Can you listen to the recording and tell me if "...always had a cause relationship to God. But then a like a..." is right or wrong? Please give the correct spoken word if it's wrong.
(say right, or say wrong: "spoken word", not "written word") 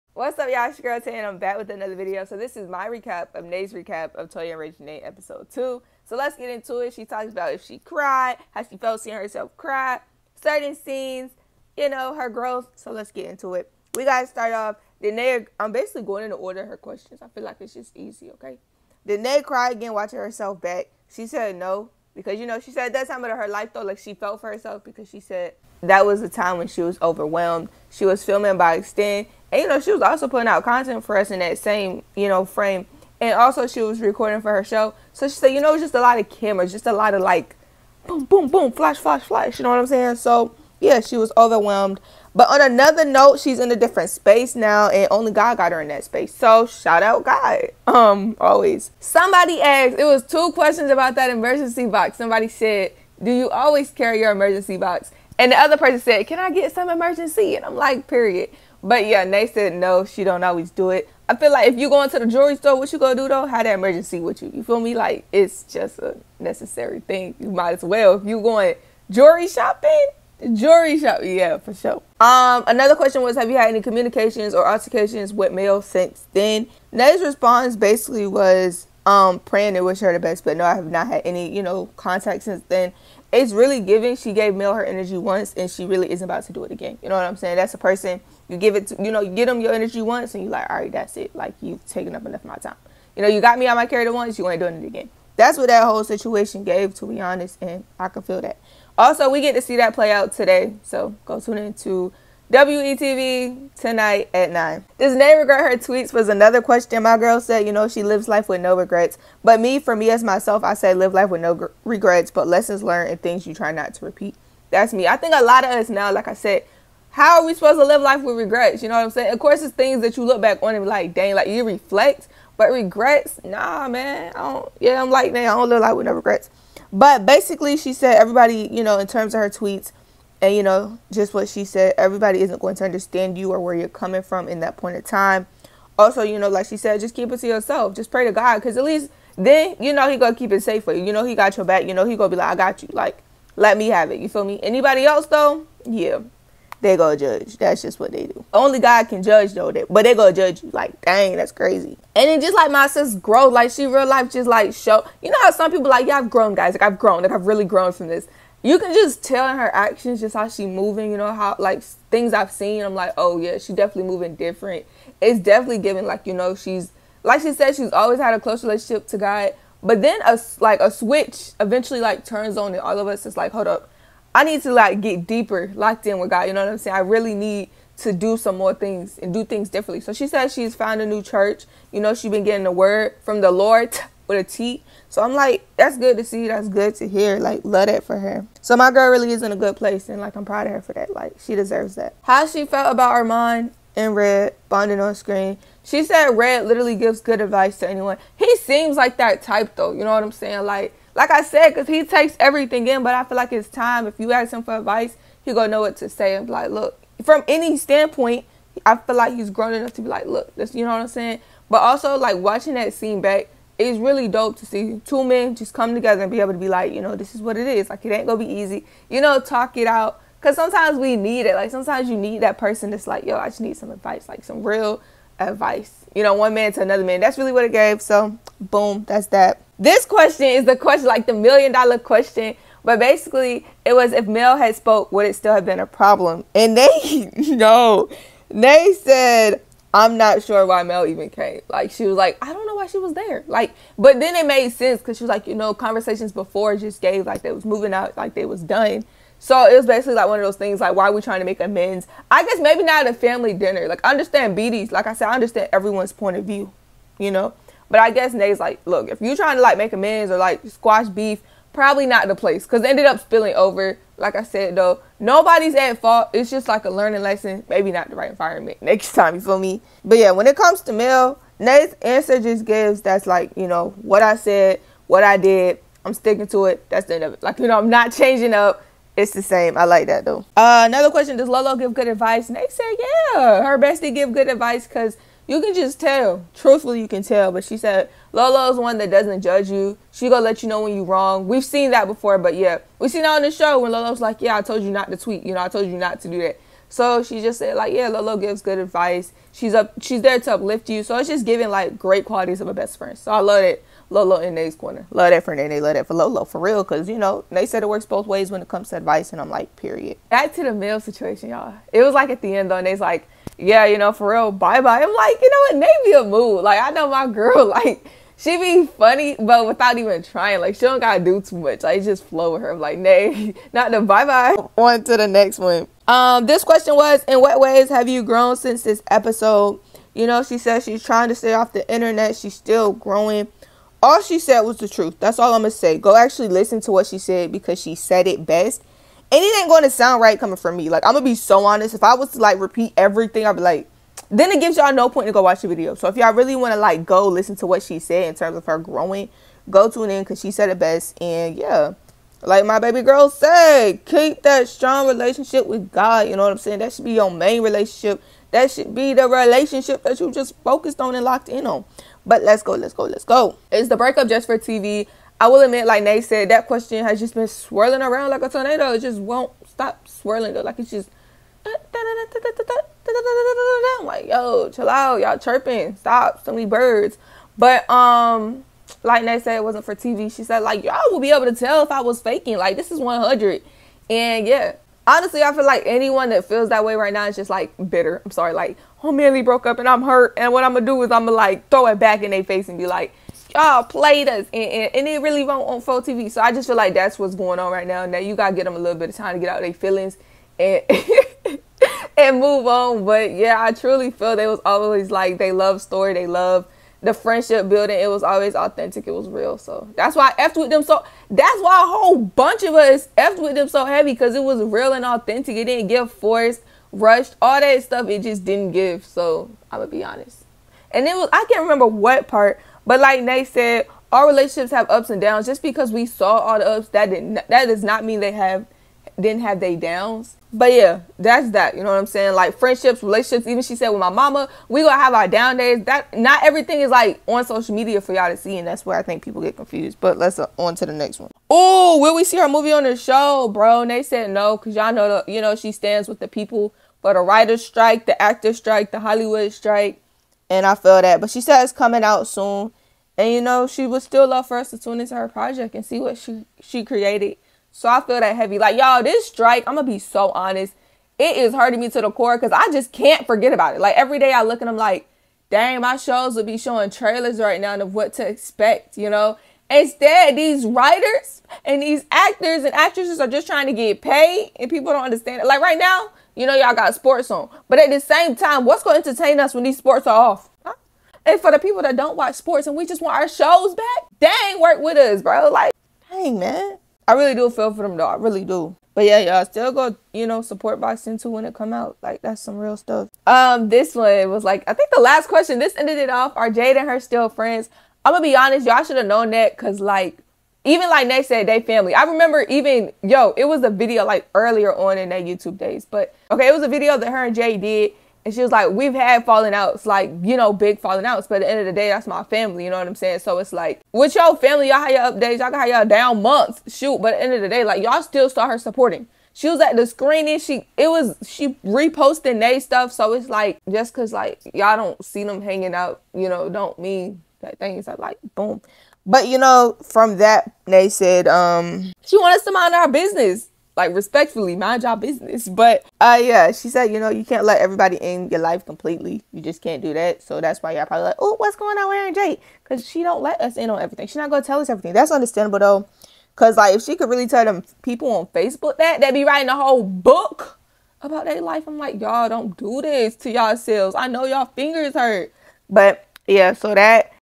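wrong: "close", not "cause".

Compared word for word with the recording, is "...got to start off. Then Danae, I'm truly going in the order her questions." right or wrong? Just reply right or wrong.
wrong.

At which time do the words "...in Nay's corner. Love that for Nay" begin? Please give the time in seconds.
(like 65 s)
304 s.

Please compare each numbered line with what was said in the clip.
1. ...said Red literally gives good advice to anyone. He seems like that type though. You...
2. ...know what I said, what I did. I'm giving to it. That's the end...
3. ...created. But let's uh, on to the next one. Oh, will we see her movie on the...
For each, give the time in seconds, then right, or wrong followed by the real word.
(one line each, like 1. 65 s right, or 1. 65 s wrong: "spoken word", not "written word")
1. 196 s right
2. 273 s wrong: "sticking", not "giving"
3. 439 s wrong: "confused", not "created".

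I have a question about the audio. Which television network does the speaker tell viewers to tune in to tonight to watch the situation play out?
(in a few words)
WETV.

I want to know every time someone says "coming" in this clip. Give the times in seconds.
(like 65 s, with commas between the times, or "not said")
133 s, 340 s, 451 s.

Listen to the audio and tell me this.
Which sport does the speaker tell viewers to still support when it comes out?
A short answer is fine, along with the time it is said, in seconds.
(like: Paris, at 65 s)
Boxing, at 490 s.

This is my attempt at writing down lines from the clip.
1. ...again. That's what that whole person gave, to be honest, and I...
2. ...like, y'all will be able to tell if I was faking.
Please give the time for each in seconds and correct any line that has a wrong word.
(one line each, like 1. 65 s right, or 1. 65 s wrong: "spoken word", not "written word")
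1. 94 s wrong: "situation", not "person"
2. 380 s right.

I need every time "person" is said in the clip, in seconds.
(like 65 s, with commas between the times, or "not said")
55 s, 87 s, 222 s.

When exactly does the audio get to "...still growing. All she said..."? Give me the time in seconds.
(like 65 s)
332 s.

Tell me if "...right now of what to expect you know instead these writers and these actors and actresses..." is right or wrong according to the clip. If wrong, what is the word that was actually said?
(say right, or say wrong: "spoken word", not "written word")
right.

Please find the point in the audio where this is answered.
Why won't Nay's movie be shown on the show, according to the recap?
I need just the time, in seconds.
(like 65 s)
448 s.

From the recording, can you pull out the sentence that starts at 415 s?
It didn't give forced, rushed, all that stuff, it just didn't give.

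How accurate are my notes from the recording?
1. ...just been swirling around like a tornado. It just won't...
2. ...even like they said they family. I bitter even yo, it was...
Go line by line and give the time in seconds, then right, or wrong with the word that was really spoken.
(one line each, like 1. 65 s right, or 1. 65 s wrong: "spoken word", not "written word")
1. 367 s right
2. 500 s wrong: "remember", not "bitter".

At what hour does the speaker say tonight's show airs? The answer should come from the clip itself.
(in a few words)
9.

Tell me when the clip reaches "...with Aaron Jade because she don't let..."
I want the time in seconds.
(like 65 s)
541 s.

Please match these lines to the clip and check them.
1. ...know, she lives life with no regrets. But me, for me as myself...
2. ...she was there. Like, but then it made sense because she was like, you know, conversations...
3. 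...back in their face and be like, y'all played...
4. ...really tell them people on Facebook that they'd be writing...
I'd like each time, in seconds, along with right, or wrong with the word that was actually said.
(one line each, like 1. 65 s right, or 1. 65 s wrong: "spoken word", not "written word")
1. 107 s right
2. 242 s right
3. 391 s right
4. 547 s right.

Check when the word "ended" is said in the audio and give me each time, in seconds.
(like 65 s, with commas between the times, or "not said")
262 s, 495 s.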